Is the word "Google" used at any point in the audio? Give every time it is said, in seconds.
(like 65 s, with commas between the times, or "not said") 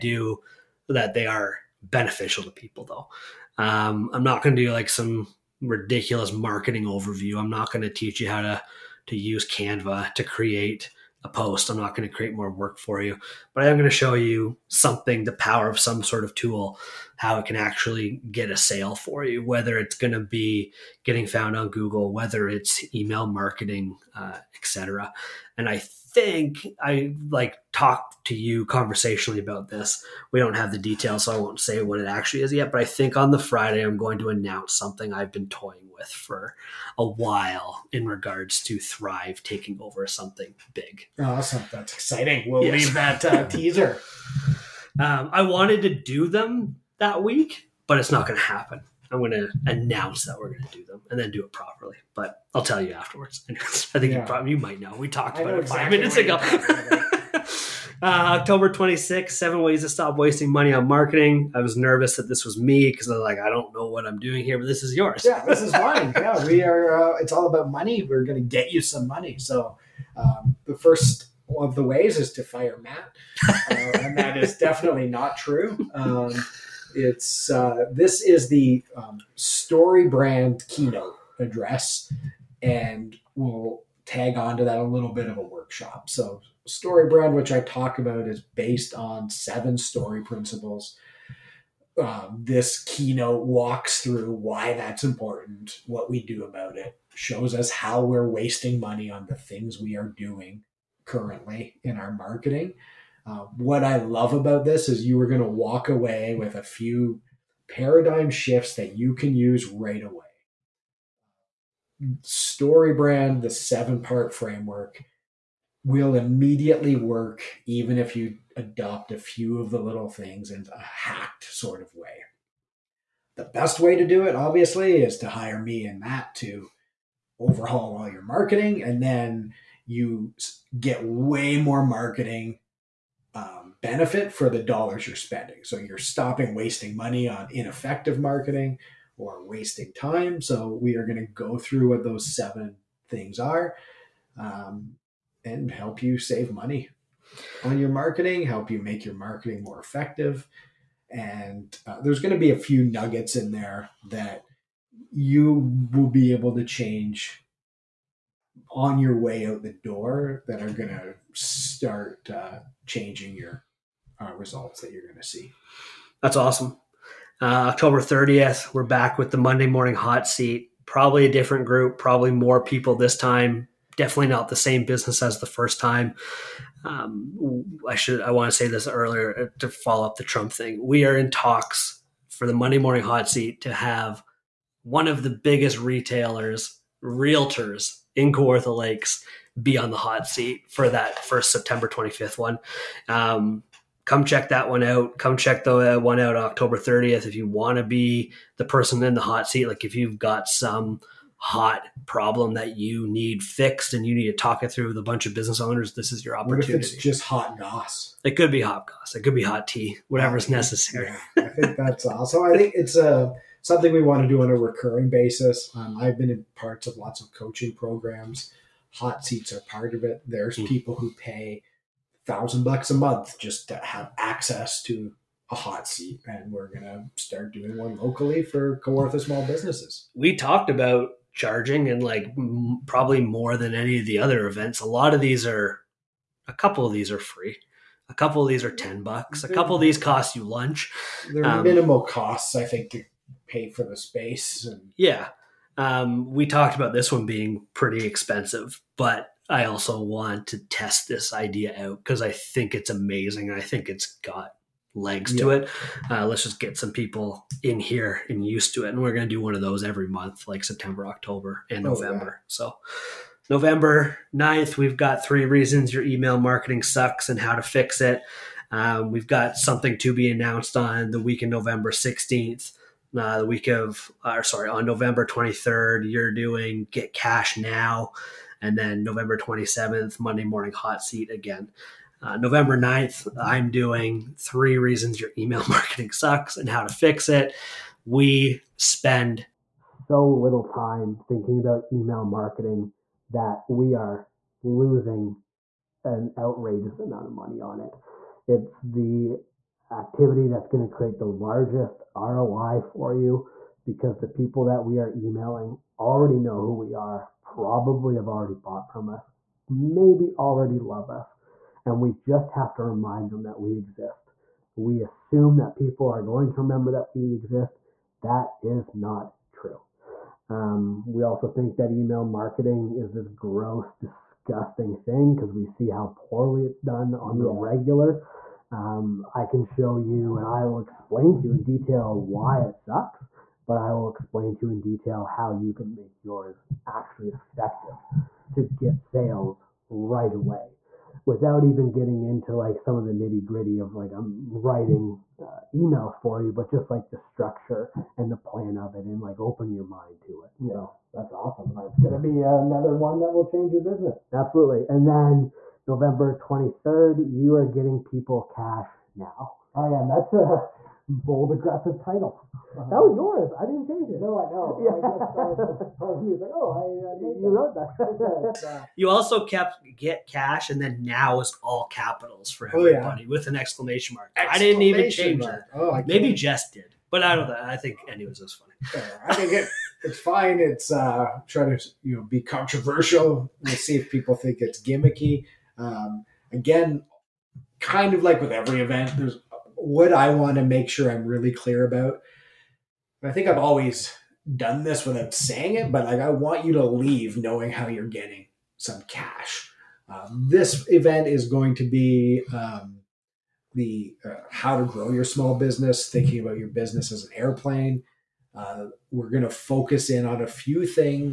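21 s.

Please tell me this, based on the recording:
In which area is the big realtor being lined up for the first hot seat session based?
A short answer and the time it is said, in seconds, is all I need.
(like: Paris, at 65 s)
Kawartha Lakes, at 188 s.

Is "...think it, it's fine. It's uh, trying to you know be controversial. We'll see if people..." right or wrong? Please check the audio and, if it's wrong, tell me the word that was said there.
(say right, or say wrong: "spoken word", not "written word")
right.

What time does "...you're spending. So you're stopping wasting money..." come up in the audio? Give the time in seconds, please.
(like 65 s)
135 s.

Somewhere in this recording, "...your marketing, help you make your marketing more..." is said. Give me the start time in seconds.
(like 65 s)
147 s.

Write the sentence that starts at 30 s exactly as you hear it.
We don't have the details, so I won't say what it actually is yet.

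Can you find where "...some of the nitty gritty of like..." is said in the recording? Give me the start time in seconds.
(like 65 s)
342 s.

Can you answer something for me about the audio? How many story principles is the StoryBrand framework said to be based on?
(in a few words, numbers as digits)
7.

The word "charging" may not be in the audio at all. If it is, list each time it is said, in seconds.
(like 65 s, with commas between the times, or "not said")
231 s.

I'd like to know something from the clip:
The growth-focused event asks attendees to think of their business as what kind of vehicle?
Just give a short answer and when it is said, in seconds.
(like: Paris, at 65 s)
an airplane, at 407 s.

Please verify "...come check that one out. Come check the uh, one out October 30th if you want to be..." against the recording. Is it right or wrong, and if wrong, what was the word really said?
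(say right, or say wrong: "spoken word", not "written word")
right.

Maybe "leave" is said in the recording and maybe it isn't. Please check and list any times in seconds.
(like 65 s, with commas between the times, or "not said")
42 s, 396 s.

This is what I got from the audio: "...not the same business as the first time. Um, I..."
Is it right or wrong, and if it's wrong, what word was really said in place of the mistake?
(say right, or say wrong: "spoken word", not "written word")
right.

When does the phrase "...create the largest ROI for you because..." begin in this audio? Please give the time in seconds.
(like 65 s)
300 s.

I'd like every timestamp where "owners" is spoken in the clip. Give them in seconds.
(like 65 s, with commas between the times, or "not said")
205 s.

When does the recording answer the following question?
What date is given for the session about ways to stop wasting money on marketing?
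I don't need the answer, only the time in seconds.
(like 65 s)
58 s.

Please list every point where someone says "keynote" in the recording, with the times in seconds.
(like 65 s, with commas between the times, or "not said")
80 s, 92 s.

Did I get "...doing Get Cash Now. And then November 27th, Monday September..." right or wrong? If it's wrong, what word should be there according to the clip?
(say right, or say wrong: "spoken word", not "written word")
wrong: "Morning", not "September".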